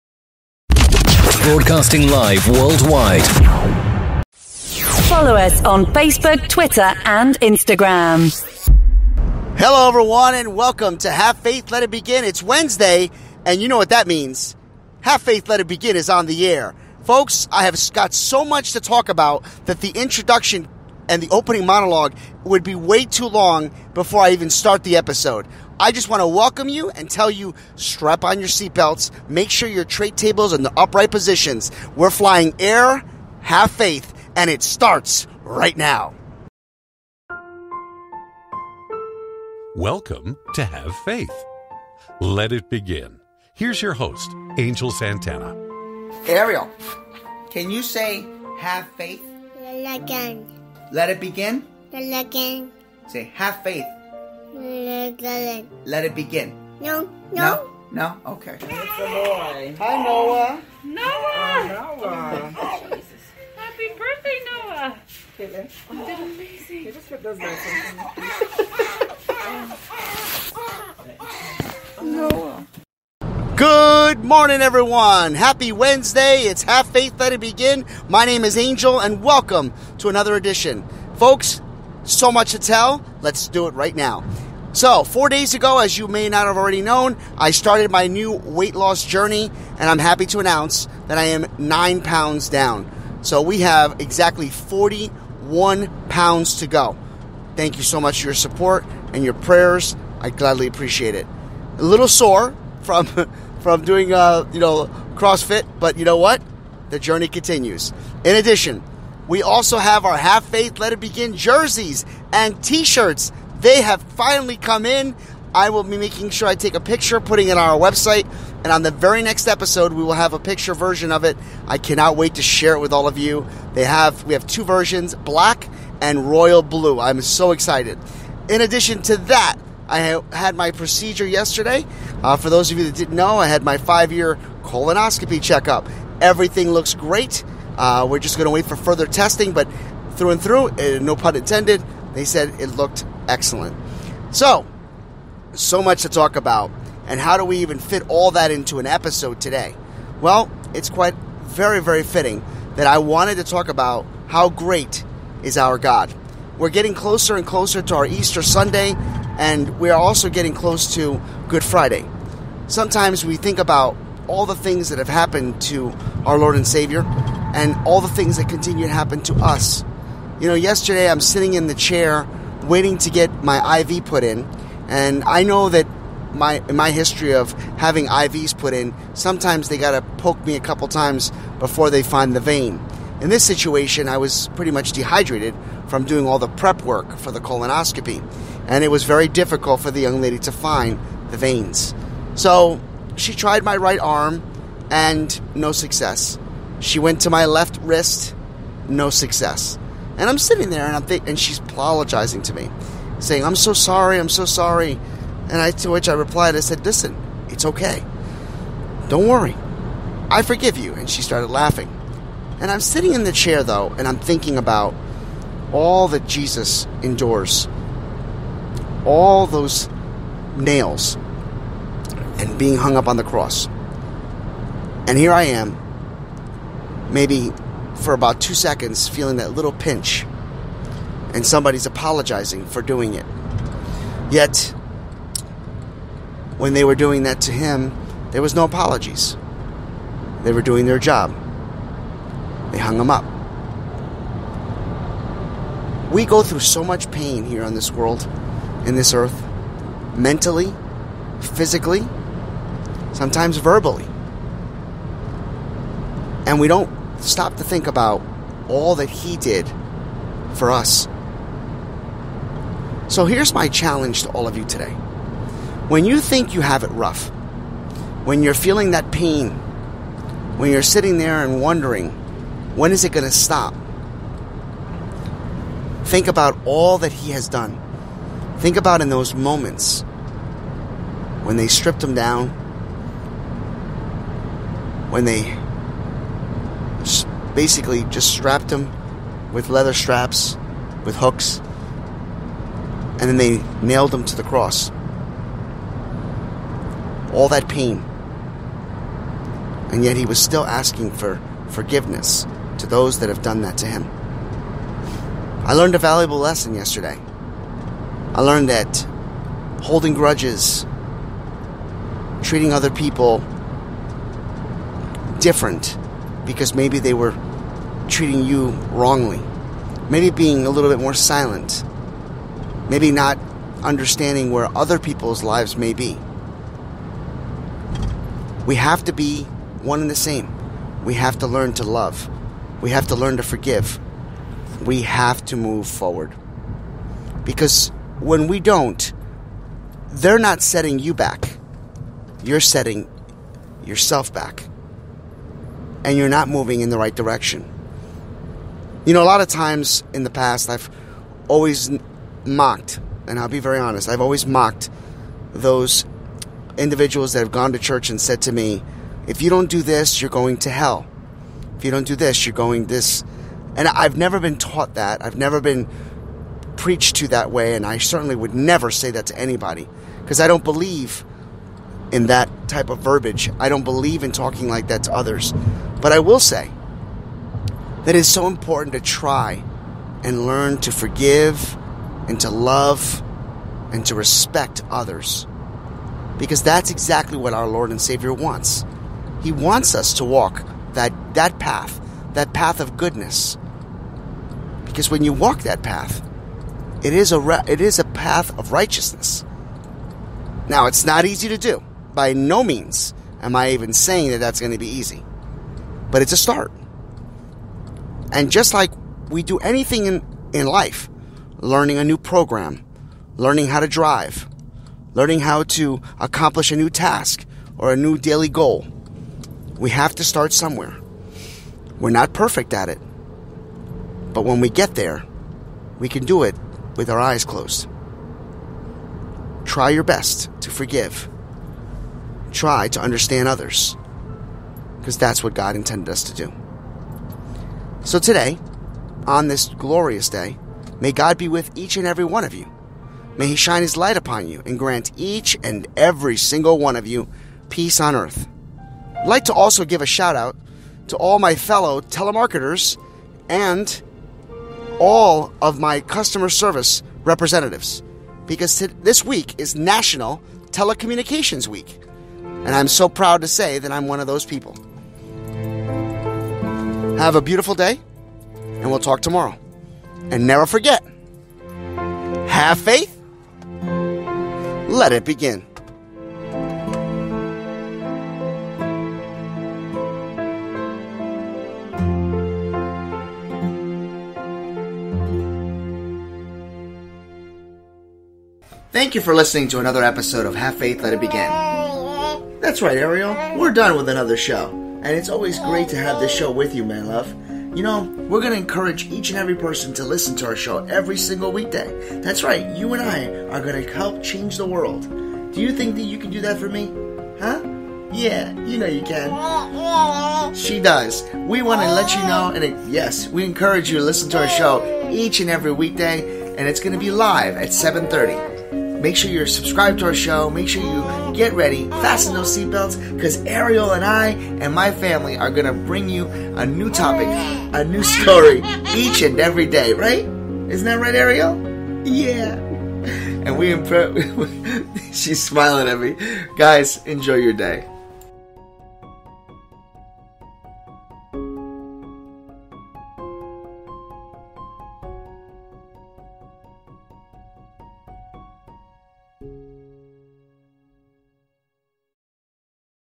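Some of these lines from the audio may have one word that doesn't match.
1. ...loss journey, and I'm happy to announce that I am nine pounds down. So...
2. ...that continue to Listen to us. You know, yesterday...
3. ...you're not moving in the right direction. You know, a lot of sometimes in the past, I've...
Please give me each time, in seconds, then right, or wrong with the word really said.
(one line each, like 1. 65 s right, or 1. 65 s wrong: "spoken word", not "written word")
1. 88 s right
2. 168 s wrong: "happen", not "Listen"
3. 346 s wrong: "times", not "sometimes".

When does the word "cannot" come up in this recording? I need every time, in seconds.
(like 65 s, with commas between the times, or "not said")
121 s.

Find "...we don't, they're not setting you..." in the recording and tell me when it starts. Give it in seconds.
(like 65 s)
338 s.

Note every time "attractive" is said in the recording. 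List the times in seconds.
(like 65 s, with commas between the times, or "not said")
not said.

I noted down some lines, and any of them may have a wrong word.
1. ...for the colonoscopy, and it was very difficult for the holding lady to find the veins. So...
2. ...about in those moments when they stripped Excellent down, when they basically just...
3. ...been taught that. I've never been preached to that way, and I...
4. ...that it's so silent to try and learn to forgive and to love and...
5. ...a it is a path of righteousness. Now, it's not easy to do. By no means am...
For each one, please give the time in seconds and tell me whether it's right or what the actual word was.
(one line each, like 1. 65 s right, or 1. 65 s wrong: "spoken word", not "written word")
1. 187 s wrong: "young", not "holding"
2. 278 s wrong: "Him", not "Excellent"
3. 364 s right
4. 378 s wrong: "important", not "silent"
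5. 397 s right.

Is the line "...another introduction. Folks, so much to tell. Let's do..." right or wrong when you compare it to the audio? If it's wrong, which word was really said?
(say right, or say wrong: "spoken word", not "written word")
wrong: "edition", not "introduction".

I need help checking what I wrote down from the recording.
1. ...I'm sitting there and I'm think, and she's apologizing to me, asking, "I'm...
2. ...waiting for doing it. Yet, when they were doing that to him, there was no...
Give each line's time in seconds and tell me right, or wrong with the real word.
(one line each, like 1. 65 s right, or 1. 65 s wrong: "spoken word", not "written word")
1. 200 s wrong: "saying", not "asking"
2. 231 s wrong: "apologizing", not "waiting".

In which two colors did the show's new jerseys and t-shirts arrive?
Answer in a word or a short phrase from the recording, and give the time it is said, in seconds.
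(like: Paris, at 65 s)
Black and royal blue, at 125 s.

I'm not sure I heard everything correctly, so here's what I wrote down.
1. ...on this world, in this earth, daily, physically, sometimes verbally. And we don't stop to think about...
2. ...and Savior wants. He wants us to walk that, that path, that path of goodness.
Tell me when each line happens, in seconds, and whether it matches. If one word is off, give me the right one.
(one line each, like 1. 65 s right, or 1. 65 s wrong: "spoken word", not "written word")
1. 247 s wrong: "mentally", not "daily"
2. 387 s right.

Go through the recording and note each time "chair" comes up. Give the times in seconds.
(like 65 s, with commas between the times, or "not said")
171 s, 213 s.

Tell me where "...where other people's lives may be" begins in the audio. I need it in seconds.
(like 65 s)
324 s.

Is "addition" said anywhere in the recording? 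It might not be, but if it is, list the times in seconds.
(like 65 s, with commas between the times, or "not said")
108 s, 128 s.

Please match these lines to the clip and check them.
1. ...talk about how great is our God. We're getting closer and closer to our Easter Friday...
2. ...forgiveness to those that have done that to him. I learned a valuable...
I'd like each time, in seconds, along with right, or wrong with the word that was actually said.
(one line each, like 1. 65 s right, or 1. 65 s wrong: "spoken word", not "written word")
1. 153 s wrong: "Sunday", not "Friday"
2. 301 s right.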